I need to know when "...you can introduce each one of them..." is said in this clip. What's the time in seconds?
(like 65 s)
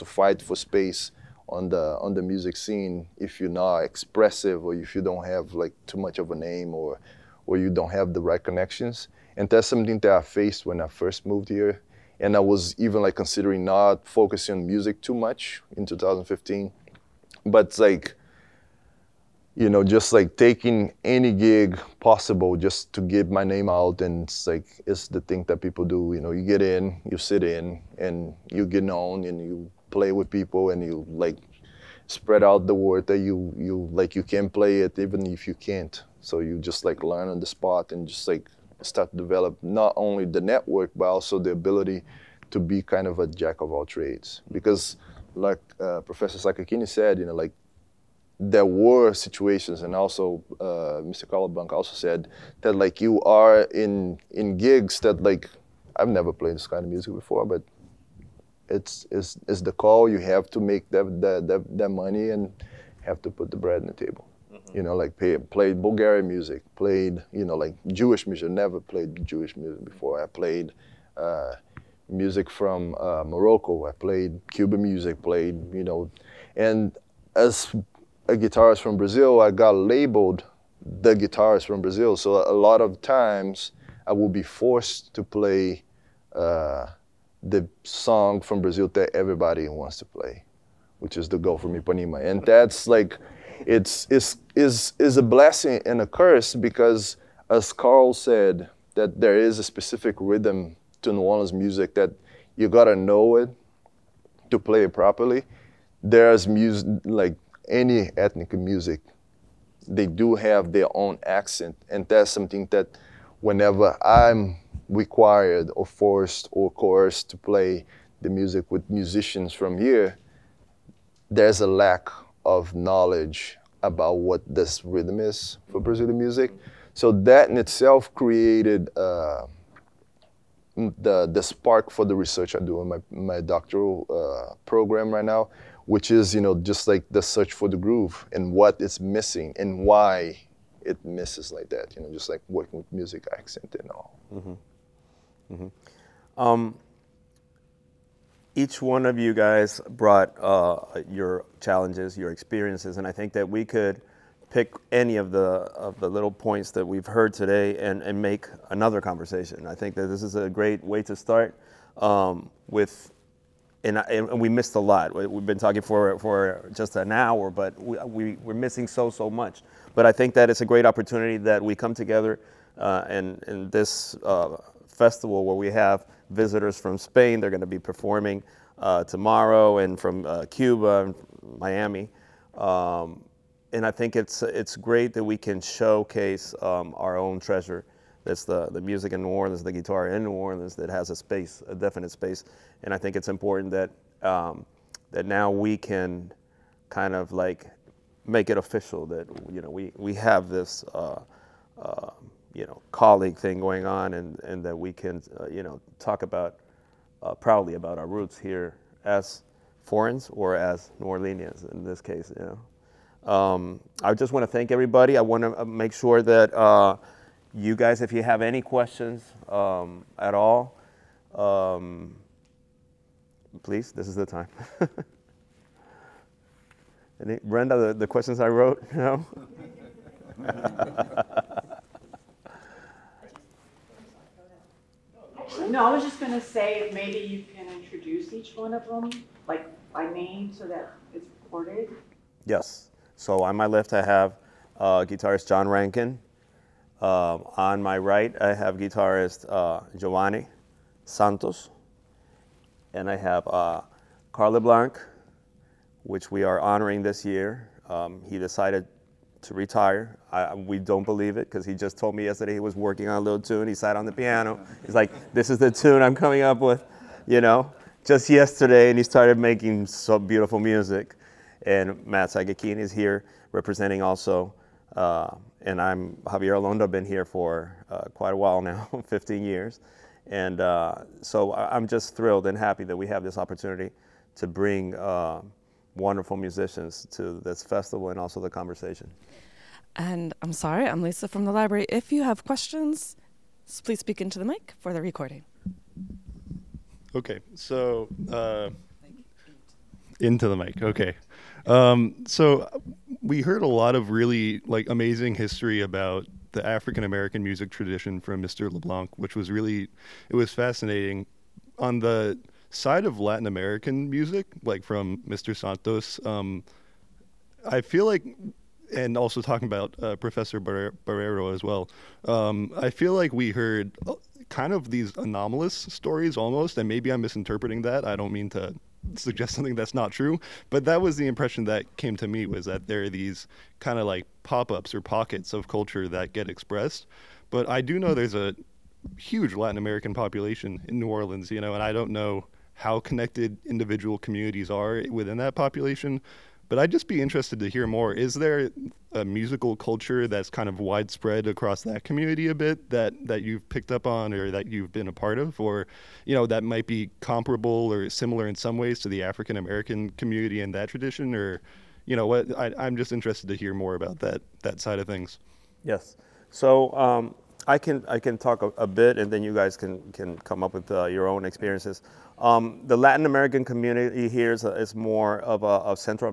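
237 s.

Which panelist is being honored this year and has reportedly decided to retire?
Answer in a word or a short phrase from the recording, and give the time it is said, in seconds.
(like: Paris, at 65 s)
Carl LeBlanc, at 254 s.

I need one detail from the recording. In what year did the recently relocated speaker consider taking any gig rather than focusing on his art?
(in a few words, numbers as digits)
2015.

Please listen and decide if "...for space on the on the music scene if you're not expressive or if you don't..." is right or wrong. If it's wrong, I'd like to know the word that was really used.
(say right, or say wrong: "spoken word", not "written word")
right.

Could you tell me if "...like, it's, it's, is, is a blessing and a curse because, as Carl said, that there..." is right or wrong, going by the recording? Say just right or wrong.
right.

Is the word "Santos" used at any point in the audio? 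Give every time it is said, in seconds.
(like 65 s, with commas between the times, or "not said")
251 s, 315 s.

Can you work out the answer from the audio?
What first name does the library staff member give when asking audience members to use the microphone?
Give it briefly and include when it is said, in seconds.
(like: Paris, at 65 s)
Lisa, at 291 s.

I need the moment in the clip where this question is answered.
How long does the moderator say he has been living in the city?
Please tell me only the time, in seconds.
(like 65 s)
279 s.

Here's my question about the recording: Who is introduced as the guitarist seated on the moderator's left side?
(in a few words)
John Rankin.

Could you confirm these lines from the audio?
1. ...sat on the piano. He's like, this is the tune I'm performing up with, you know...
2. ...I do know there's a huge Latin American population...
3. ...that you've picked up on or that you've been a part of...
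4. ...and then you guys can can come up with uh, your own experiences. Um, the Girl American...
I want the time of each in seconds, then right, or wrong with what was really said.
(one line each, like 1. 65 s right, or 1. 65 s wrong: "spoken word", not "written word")
1. 263 s wrong: "coming", not "performing"
2. 337 s right
3. 353 s right
4. 369 s wrong: "Latin", not "Girl".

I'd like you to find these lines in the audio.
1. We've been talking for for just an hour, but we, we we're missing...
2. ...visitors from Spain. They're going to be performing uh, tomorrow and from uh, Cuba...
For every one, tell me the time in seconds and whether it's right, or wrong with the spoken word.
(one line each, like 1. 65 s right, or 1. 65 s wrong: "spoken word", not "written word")
1. 165 s right
2. 176 s right.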